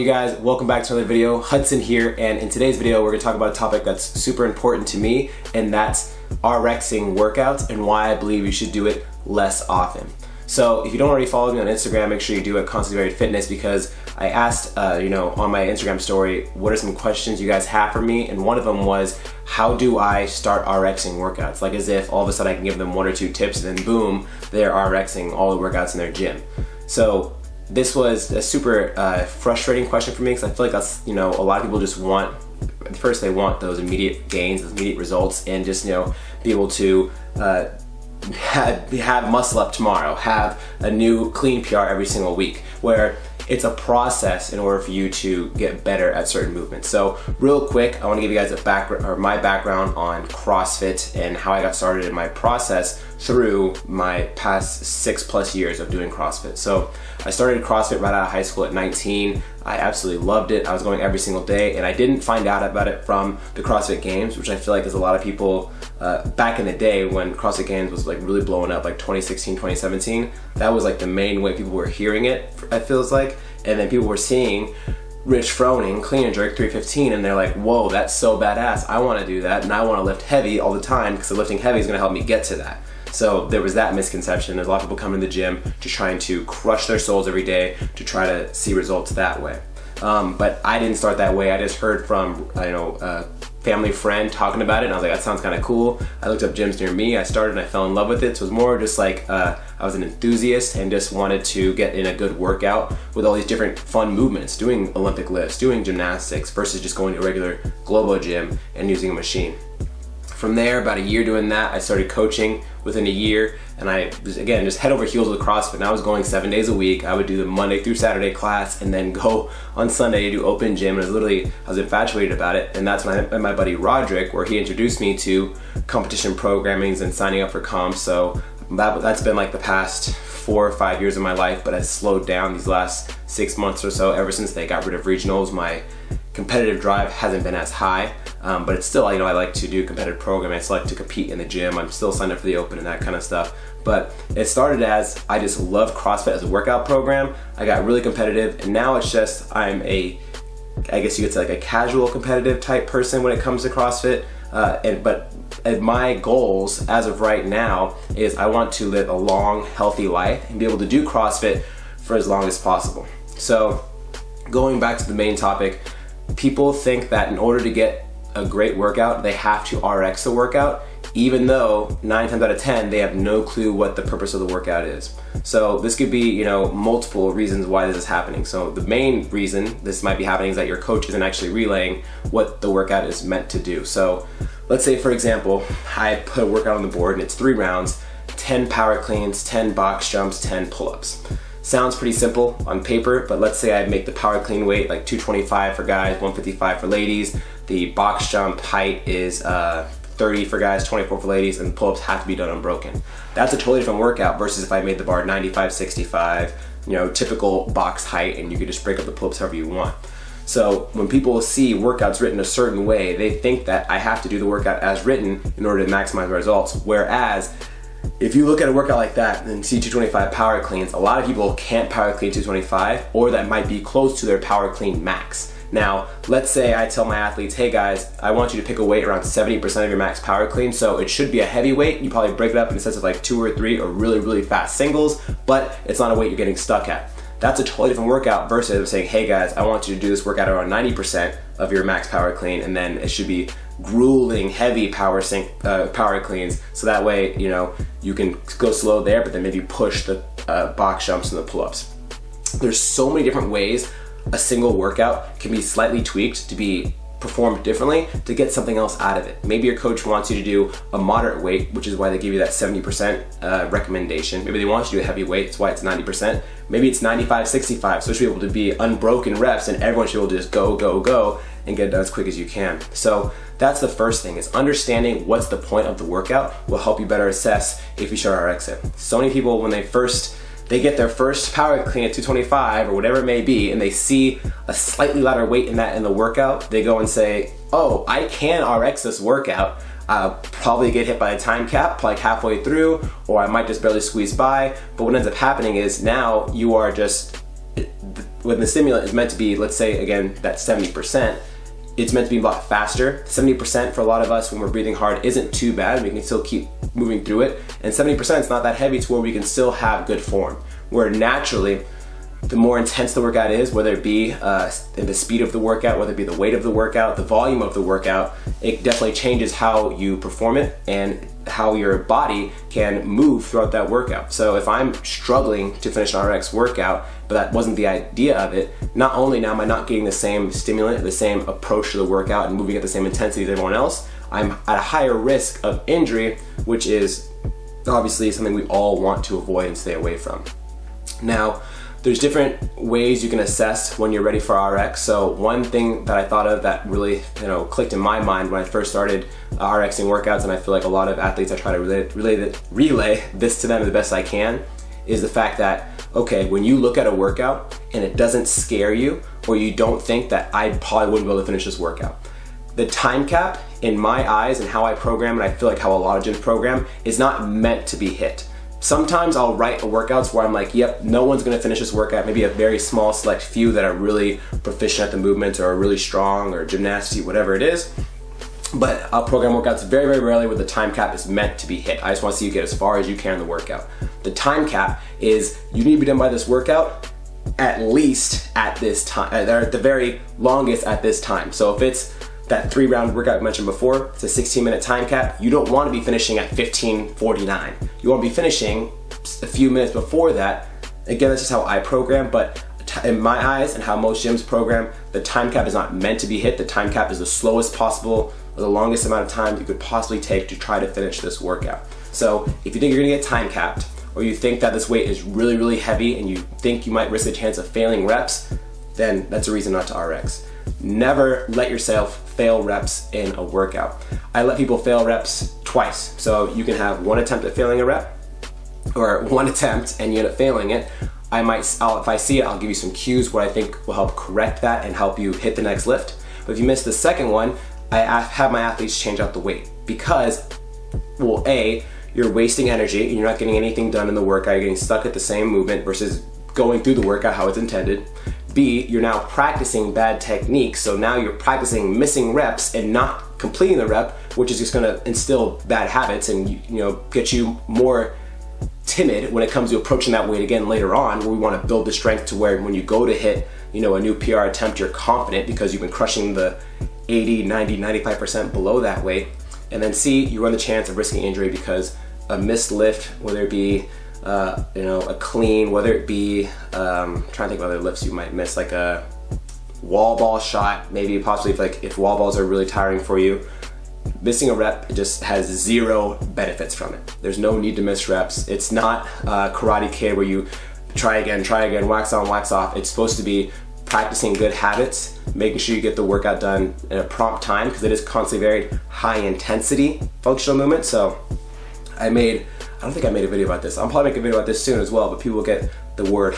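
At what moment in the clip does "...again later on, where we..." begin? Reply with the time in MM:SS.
07:40.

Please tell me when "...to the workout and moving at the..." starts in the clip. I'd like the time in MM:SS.
05:31.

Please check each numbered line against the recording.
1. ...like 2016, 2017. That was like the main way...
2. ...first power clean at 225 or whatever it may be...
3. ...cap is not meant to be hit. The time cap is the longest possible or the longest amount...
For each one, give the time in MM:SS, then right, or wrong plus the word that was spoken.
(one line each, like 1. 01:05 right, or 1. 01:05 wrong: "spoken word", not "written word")
1. 01:08 right
2. 04:41 right
3. 06:45 wrong: "slowest", not "longest".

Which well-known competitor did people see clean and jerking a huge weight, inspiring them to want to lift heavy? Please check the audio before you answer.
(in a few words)
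Rich Froning.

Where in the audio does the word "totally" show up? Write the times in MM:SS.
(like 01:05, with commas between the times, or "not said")
03:23, 03:57.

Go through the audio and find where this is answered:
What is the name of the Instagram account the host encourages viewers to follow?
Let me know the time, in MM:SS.
00:12.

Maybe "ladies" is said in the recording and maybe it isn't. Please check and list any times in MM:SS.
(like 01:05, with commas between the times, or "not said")
03:16, 03:21.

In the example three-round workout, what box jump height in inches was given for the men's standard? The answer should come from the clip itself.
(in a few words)
30.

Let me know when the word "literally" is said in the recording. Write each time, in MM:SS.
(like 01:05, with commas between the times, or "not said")
02:01.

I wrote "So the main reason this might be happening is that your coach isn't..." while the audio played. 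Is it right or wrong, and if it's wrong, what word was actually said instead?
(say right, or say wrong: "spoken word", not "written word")
right.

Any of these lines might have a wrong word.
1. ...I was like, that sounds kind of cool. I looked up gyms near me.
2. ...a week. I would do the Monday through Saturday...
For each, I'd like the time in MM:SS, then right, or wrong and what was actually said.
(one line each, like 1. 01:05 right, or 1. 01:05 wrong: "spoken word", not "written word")
1. 01:34 right
2. 01:56 right.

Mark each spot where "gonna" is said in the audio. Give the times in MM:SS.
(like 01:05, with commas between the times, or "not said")
01:21, 06:11, 06:53, 07:34.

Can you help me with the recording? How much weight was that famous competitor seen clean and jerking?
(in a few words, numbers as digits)
315.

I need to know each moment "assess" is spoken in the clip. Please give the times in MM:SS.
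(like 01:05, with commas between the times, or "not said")
04:37, 05:43.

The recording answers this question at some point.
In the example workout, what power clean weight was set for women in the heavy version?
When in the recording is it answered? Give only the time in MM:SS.
03:16.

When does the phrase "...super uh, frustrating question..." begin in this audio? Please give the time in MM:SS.
00:28.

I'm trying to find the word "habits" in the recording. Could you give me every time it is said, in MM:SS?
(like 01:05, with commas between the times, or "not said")
07:35, 08:14.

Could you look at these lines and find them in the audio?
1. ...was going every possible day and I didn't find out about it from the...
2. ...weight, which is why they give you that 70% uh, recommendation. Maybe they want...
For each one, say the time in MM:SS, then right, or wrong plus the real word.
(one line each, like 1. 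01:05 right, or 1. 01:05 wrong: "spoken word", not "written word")
1. 01:00 wrong: "single", not "possible"
2. 04:21 right.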